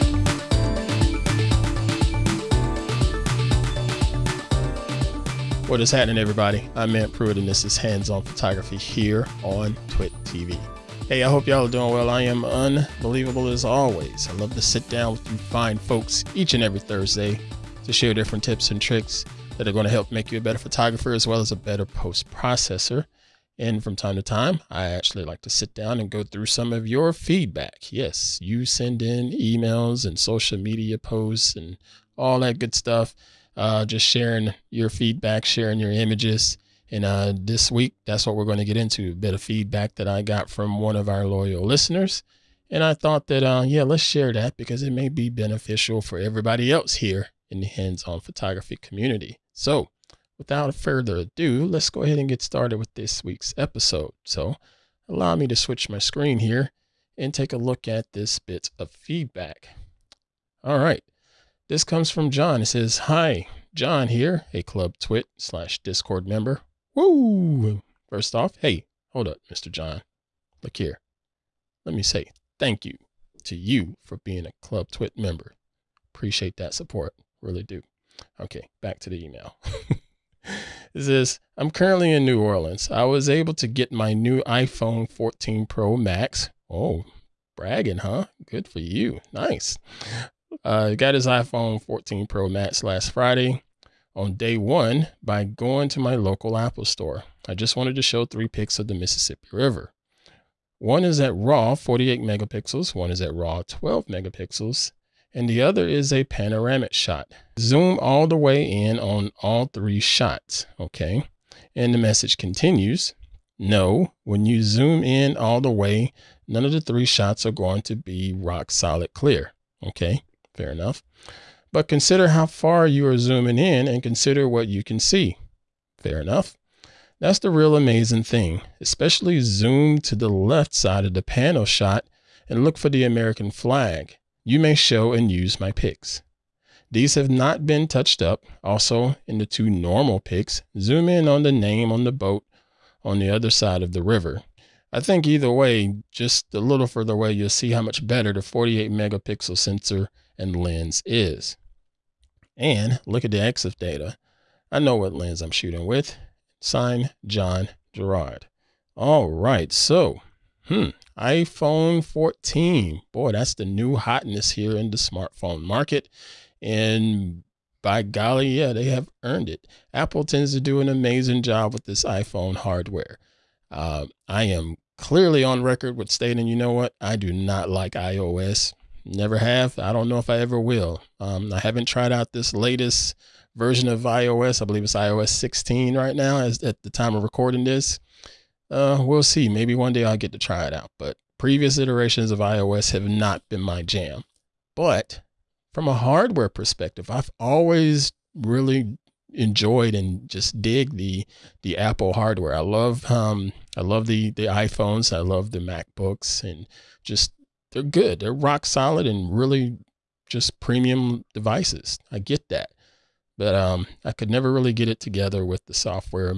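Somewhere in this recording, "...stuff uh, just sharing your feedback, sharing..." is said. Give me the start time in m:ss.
0:32.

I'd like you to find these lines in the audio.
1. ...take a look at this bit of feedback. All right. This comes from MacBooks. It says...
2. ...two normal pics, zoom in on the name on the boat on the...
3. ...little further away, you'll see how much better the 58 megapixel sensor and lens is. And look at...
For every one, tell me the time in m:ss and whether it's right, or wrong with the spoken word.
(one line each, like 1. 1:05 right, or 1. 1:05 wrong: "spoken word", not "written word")
1. 0:57 wrong: "John", not "MacBooks"
2. 2:19 right
3. 2:26 wrong: "48", not "58".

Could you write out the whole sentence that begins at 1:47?
Zoom all the way in on all three shots, okay?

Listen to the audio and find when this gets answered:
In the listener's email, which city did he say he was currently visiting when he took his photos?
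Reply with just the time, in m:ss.
1:22.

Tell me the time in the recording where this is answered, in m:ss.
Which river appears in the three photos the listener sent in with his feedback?
1:38.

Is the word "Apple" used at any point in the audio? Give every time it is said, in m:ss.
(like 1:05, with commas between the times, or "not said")
1:36, 2:49, 3:21.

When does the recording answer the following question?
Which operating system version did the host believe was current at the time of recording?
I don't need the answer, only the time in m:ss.
3:04.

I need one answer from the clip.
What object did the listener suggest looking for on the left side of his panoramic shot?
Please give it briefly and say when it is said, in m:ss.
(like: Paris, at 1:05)
American flag, at 2:13.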